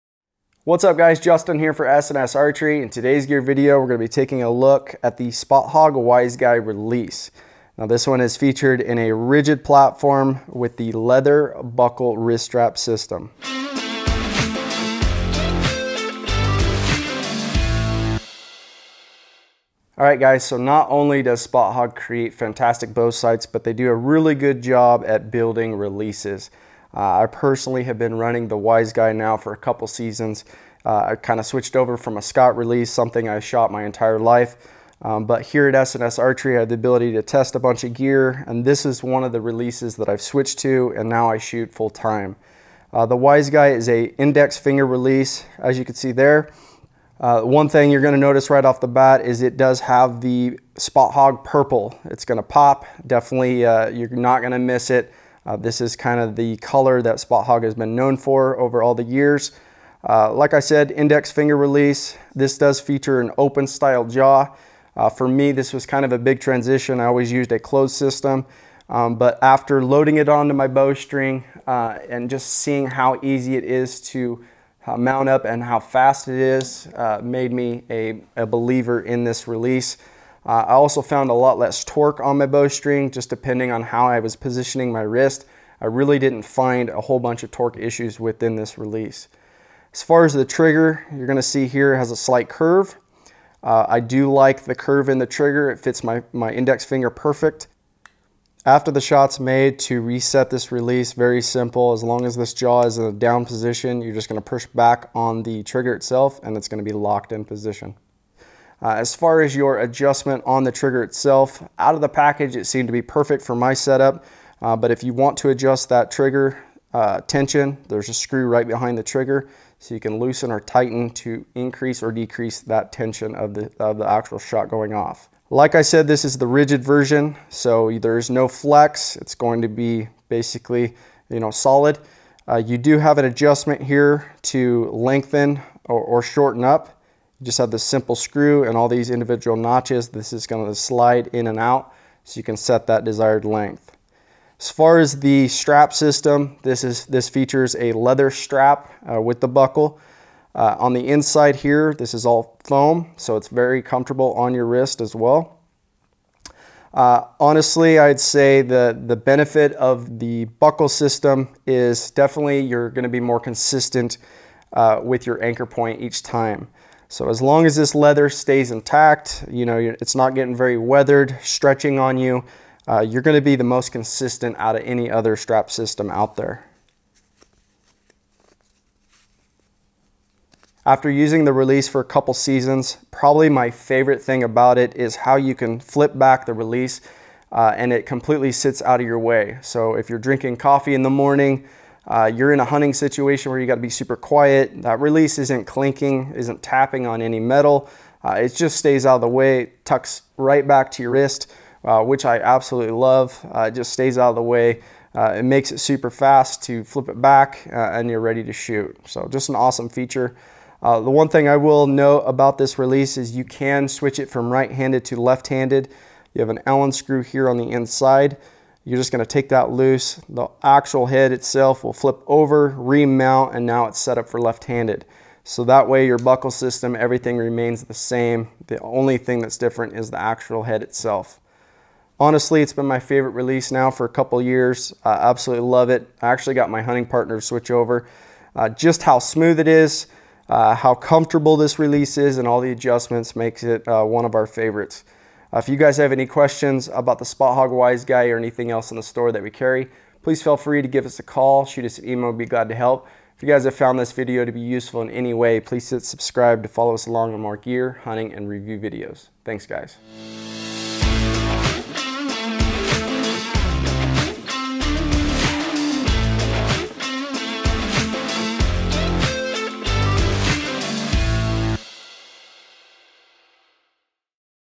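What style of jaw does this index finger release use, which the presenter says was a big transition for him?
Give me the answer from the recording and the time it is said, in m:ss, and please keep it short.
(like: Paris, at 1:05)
open style jaw, at 1:03.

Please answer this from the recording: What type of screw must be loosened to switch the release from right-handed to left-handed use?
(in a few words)
Allen screw.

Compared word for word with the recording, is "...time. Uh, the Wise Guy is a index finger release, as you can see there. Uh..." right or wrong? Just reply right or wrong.
right.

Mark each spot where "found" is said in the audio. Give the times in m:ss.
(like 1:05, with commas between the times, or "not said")
1:21, 4:13.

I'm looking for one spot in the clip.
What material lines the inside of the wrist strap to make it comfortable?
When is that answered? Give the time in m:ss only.
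2:32.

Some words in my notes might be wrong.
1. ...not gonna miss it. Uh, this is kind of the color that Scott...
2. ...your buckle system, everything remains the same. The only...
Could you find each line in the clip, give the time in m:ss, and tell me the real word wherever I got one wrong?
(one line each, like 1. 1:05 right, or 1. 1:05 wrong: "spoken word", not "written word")
1. 0:54 wrong: "Spot", not "Scott"
2. 3:46 right.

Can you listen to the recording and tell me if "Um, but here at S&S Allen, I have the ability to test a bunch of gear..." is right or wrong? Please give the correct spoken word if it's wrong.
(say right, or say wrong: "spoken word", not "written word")
wrong: "Archery", not "Allen".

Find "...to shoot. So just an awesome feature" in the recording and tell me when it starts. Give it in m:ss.
3:28.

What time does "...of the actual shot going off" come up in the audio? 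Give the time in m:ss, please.
2:03.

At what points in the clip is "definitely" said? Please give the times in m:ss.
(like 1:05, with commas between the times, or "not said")
0:53, 2:42.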